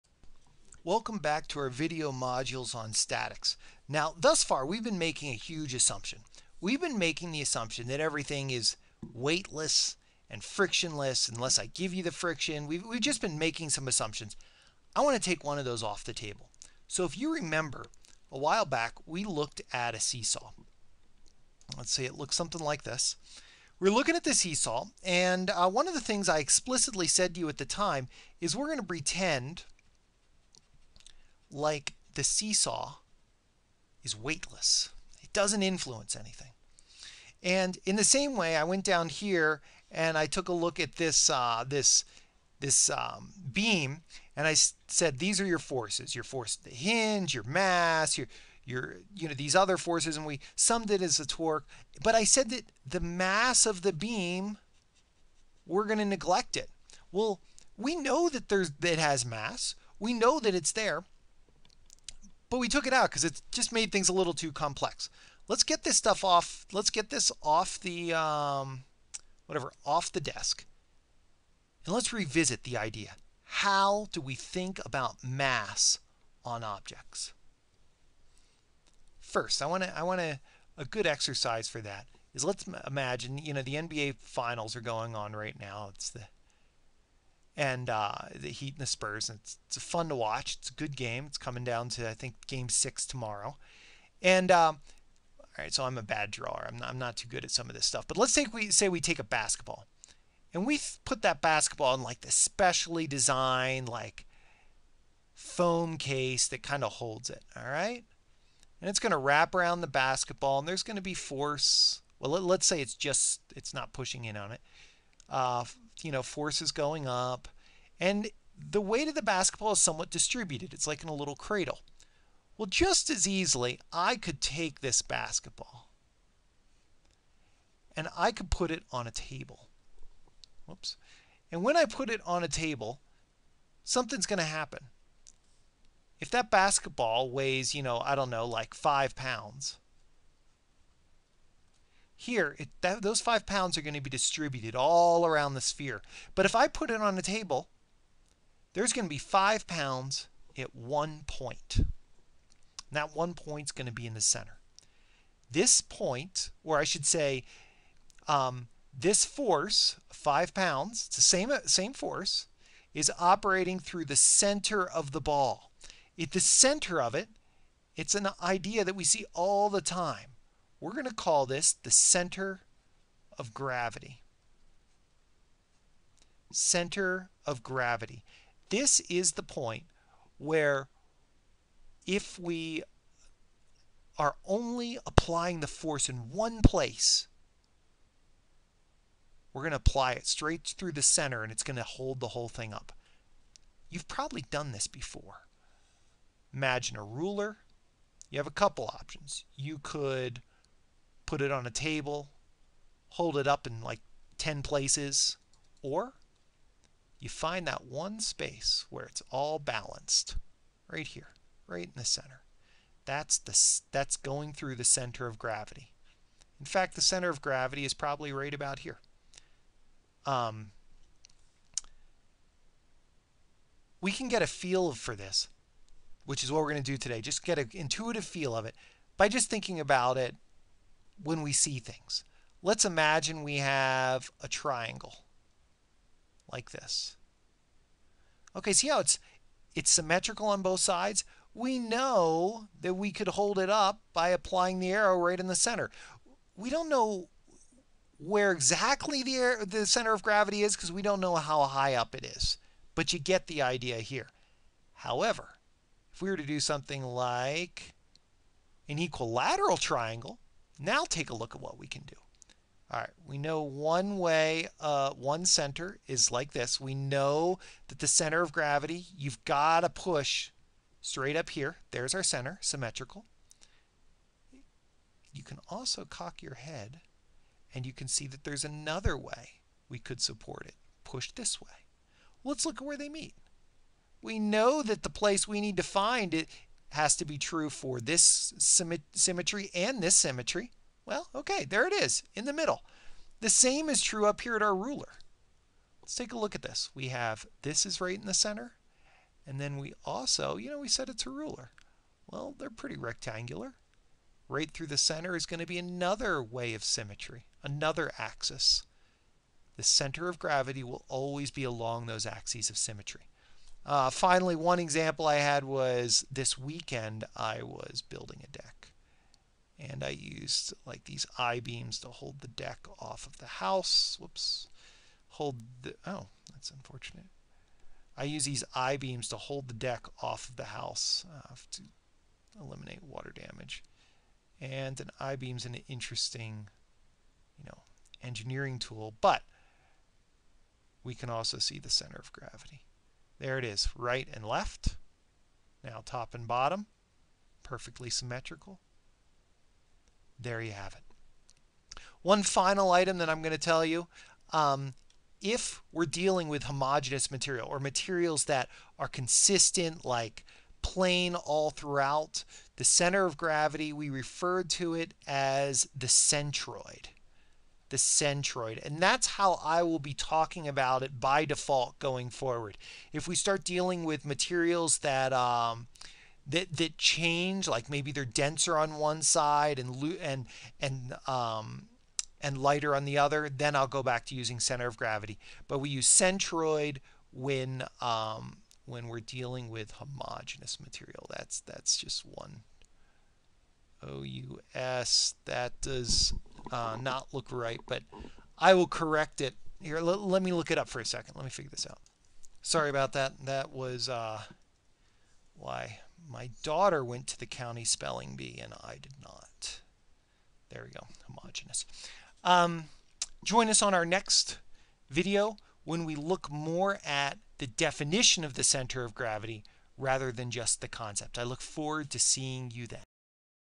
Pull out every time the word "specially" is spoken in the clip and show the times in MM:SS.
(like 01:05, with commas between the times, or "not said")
01:42.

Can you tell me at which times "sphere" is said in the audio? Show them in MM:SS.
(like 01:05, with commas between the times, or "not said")
02:25.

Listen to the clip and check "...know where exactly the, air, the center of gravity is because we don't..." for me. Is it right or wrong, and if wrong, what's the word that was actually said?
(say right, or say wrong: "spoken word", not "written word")
right.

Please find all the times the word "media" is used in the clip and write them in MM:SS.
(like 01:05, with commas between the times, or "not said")
not said.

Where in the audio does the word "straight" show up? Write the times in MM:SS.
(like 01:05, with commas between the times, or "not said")
03:10, 04:30.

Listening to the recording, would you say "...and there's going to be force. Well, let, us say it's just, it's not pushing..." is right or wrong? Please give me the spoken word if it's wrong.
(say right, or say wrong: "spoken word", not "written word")
right.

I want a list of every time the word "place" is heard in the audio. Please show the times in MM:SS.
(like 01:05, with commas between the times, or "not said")
03:06, 03:24, 04:45.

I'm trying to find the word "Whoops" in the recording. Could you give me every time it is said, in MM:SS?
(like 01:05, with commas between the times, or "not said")
02:10, 05:24.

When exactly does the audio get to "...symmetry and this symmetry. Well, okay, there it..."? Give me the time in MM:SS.
04:49.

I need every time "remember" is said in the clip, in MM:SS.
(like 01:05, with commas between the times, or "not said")
00:17.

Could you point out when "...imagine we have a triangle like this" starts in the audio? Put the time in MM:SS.
03:52.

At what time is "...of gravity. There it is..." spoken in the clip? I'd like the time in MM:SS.
05:42.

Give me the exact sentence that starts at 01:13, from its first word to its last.
How do we think about mass on objects?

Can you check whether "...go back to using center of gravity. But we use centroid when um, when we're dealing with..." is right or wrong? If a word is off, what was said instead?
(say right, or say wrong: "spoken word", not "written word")
right.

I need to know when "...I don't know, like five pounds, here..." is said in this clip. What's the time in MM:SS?
02:18.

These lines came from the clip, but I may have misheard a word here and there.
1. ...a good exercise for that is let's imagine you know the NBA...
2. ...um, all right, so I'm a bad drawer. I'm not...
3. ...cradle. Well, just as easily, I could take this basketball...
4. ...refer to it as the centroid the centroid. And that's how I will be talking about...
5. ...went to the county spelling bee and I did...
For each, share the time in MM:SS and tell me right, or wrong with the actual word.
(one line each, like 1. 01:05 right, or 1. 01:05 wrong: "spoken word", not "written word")
1. 01:20 right
2. 01:34 right
3. 02:01 right
4. 06:04 right
5. 06:47 right.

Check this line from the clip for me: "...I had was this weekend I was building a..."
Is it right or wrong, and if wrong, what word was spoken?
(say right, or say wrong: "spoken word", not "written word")
right.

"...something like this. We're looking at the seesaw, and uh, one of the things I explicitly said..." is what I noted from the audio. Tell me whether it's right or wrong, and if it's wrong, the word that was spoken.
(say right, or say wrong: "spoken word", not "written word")
right.